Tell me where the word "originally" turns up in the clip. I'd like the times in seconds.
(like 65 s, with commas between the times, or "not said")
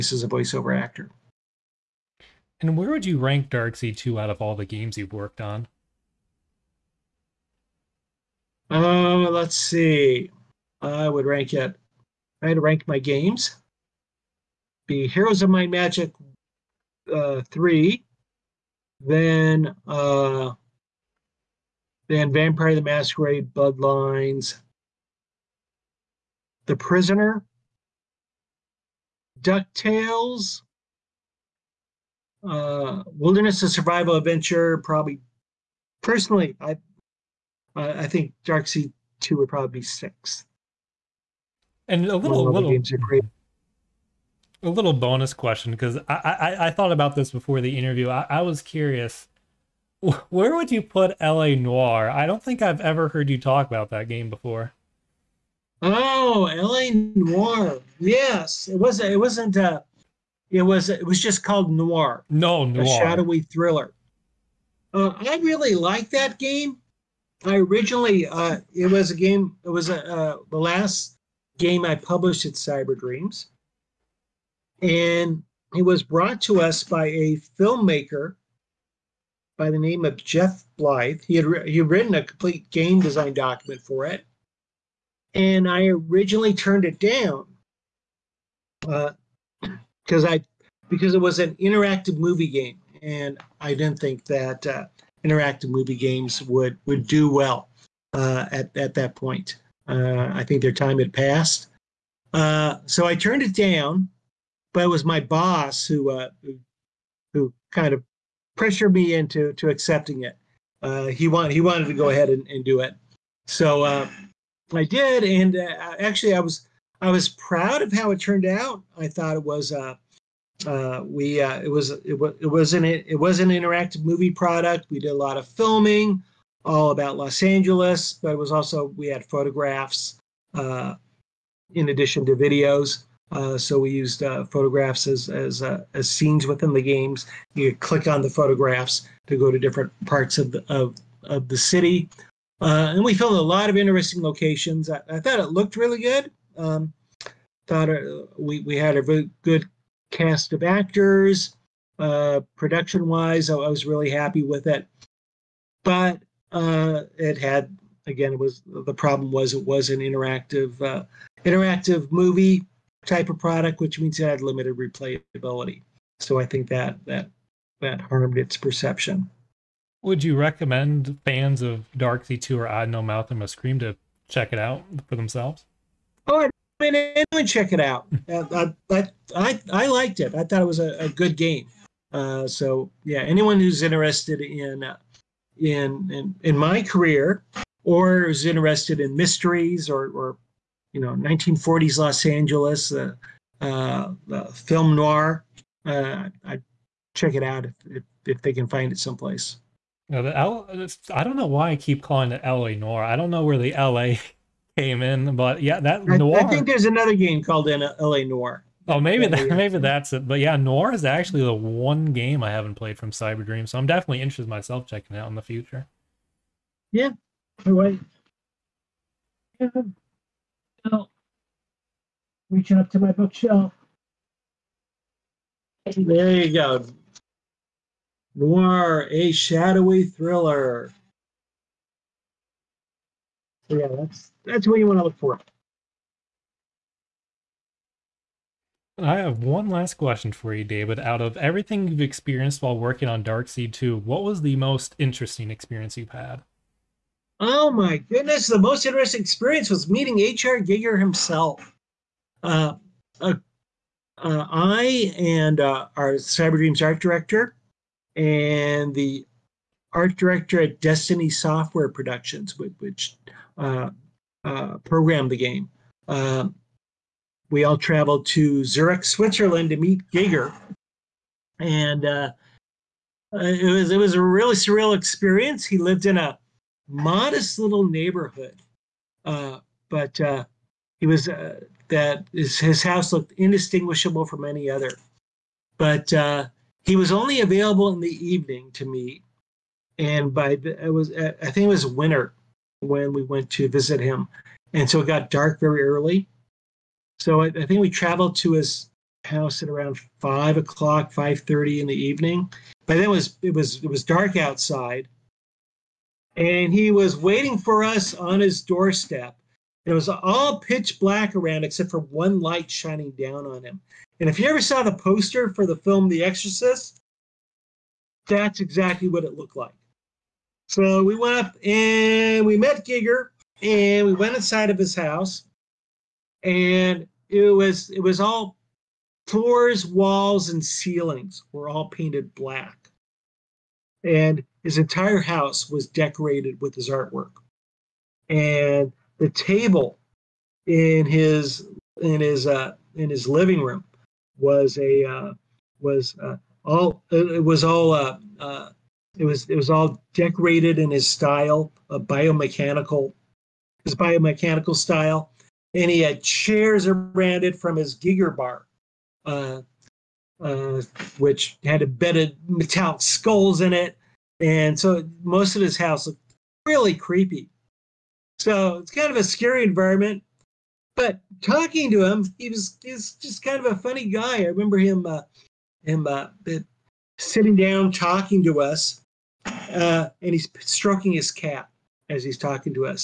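67 s, 85 s.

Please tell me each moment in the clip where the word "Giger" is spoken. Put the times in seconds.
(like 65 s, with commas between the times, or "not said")
250 s, 270 s, 322 s, 357 s.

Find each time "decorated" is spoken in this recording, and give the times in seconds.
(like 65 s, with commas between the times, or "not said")
335 s, 350 s.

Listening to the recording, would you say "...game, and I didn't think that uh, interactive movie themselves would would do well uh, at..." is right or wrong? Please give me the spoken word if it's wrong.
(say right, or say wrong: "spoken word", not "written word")
wrong: "games", not "themselves".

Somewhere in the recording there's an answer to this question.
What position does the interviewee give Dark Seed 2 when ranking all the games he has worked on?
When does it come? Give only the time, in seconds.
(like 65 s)
39 s.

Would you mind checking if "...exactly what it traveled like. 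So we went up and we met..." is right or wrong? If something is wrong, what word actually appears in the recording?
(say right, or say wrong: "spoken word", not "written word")
wrong: "looked", not "traveled".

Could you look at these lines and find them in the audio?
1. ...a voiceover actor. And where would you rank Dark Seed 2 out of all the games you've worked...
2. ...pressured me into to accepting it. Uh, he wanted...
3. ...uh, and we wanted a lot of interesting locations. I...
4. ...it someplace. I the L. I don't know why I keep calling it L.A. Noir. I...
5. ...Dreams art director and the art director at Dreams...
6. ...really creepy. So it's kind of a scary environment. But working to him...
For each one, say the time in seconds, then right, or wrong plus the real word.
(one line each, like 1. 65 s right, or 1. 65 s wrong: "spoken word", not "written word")
1. 0 s right
2. 108 s right
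3. 142 s wrong: "filmed", not "wanted"
4. 198 s right
5. 256 s wrong: "Destiny", not "Dreams"
6. 366 s wrong: "talking", not "working".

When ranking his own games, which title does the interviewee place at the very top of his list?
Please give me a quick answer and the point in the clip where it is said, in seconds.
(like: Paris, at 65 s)
Heroes of Might and Magic 3, at 15 s.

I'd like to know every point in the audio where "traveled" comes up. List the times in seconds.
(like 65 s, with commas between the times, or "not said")
267 s, 297 s.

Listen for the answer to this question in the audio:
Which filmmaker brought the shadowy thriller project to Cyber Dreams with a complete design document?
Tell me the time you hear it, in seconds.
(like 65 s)
80 s.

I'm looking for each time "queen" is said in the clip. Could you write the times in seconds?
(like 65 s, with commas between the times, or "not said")
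not said.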